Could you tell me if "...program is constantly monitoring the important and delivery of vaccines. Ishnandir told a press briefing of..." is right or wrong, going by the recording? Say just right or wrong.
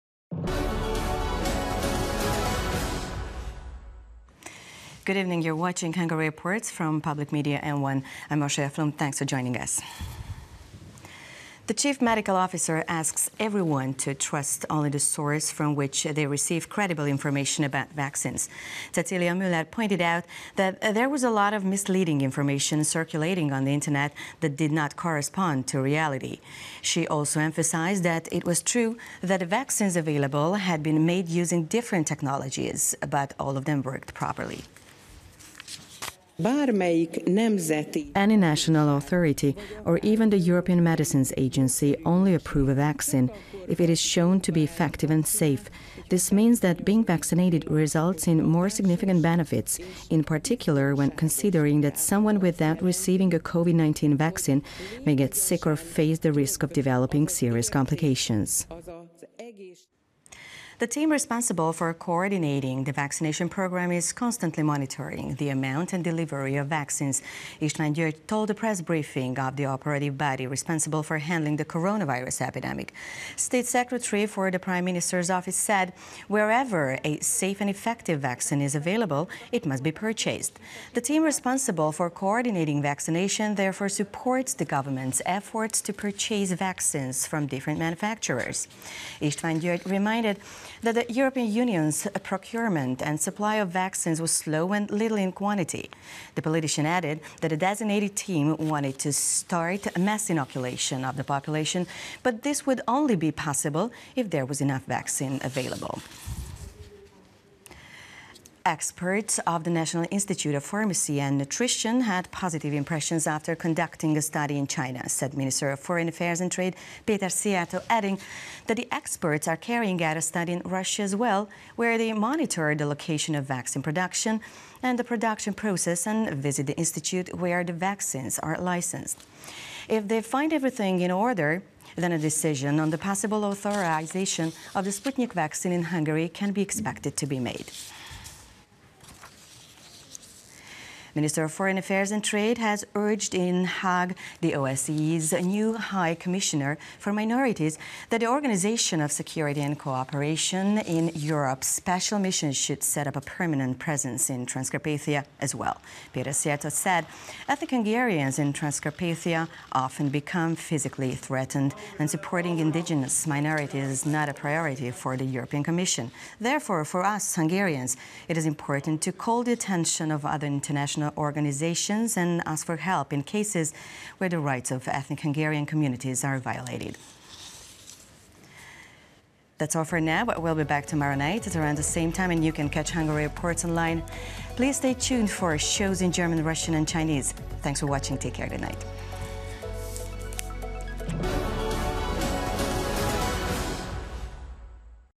wrong.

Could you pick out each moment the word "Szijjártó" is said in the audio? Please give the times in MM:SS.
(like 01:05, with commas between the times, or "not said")
01:57, 02:36.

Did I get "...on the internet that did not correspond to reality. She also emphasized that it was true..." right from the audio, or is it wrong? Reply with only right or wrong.
right.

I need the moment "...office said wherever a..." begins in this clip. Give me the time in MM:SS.
01:15.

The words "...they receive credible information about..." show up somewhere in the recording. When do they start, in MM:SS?
00:16.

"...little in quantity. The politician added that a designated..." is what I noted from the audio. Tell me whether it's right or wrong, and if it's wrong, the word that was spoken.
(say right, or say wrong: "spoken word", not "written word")
right.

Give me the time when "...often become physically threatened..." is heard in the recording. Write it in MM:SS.
02:39.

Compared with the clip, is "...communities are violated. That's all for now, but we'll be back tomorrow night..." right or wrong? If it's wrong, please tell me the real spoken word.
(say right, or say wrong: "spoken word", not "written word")
right.